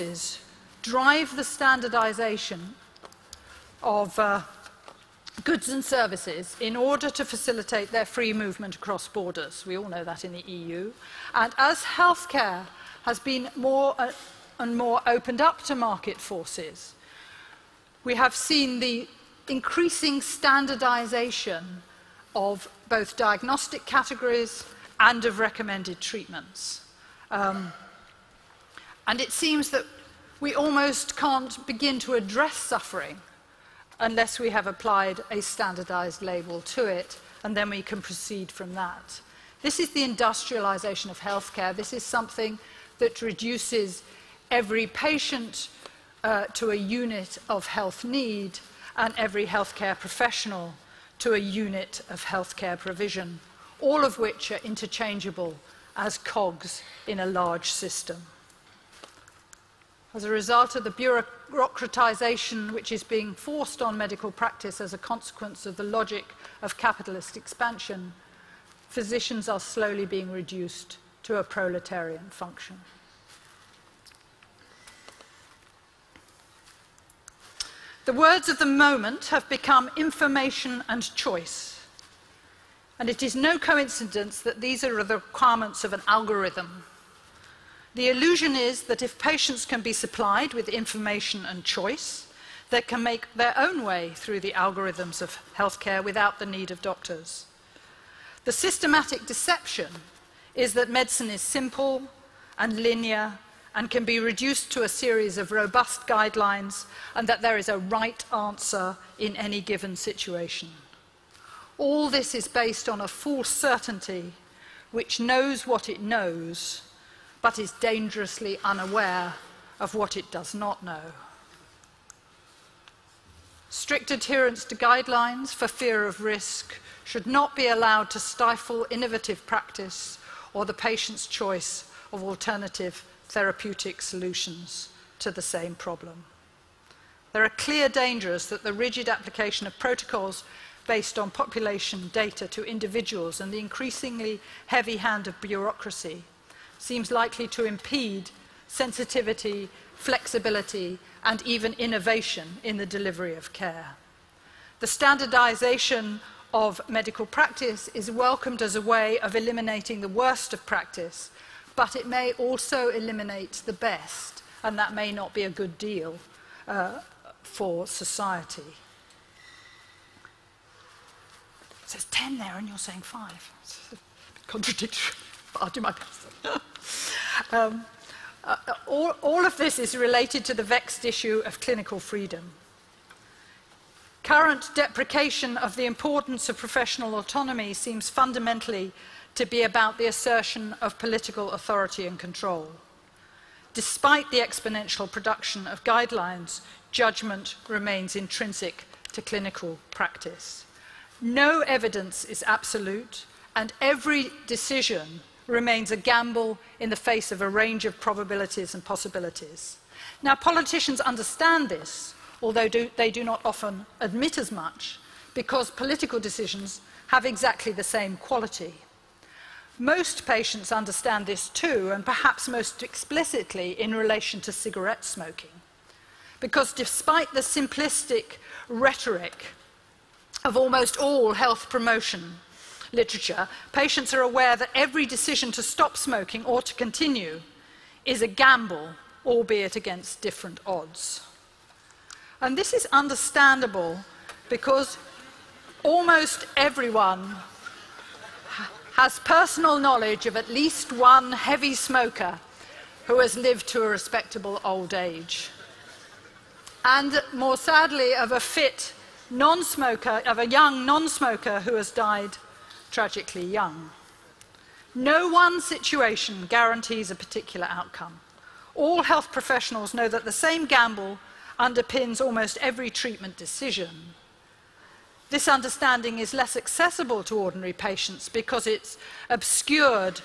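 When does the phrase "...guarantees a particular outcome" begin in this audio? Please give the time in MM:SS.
04:26.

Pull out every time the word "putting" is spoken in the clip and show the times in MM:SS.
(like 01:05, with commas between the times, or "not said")
not said.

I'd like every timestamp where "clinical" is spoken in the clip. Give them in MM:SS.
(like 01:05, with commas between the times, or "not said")
03:01, 03:19.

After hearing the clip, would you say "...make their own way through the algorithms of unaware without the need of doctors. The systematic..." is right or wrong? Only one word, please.
wrong.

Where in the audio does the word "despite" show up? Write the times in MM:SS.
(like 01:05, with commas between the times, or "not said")
03:13, 03:46.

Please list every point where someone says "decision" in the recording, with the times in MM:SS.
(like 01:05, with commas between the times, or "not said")
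03:24, 03:36, 03:55, 04:33.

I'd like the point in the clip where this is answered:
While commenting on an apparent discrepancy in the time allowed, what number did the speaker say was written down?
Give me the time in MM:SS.
02:52.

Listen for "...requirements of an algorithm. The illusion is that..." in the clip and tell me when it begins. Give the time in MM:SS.
01:25.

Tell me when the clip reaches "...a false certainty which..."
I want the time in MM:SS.
01:53.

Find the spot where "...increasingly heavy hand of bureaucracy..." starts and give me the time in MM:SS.
02:23.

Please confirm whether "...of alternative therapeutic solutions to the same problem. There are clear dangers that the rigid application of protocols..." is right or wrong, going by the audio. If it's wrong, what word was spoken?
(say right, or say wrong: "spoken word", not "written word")
right.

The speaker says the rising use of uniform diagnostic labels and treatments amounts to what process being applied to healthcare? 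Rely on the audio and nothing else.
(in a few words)
industrialization.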